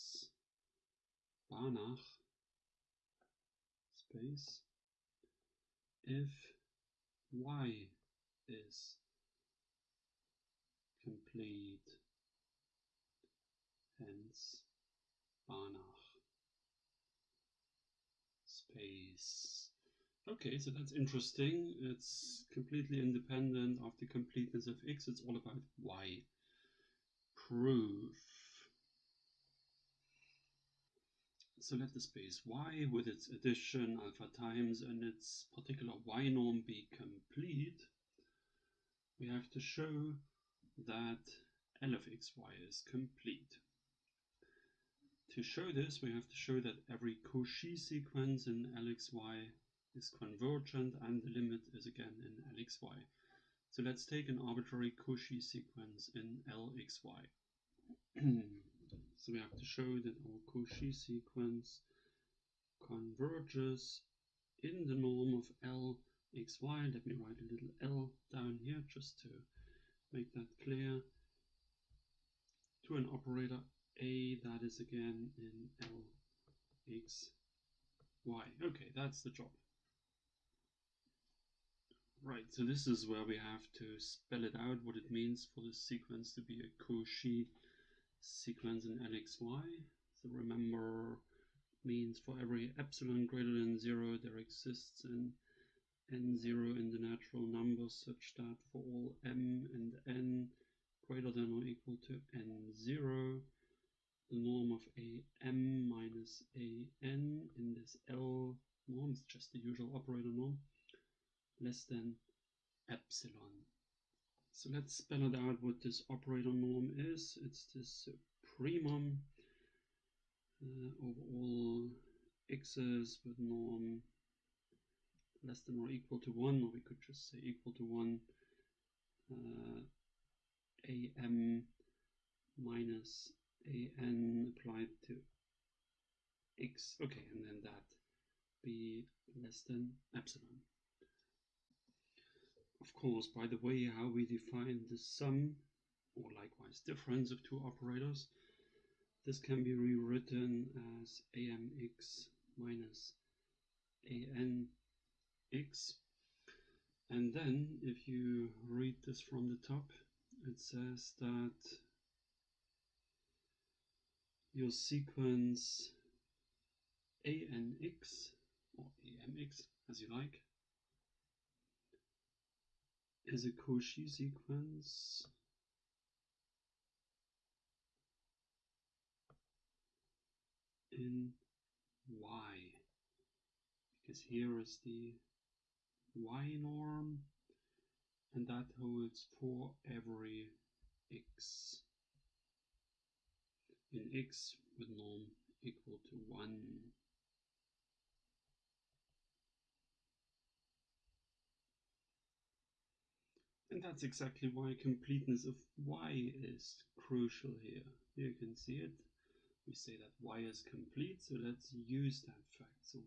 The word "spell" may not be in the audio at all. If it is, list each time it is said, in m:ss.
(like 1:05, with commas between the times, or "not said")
1:24, 1:54.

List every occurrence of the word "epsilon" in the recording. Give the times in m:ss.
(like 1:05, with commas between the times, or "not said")
1:32, 1:52, 2:20.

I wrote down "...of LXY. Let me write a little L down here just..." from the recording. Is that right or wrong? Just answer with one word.
right.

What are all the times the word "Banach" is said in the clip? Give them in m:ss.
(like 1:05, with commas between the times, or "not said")
0:01, 0:15.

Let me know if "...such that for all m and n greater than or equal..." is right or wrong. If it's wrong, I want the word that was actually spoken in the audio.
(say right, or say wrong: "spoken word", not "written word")
right.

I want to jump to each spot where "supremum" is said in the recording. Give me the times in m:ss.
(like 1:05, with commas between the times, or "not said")
1:58.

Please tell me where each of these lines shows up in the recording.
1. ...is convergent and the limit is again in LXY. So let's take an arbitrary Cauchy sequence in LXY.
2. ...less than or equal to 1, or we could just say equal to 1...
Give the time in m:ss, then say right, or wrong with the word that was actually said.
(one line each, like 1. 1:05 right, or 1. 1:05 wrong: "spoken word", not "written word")
1. 0:49 right
2. 2:05 right.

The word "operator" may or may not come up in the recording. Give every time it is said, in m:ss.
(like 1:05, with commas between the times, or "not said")
1:13, 1:49, 1:56, 2:27.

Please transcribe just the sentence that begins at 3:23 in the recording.
And that's exactly why completeness of y is crucial here.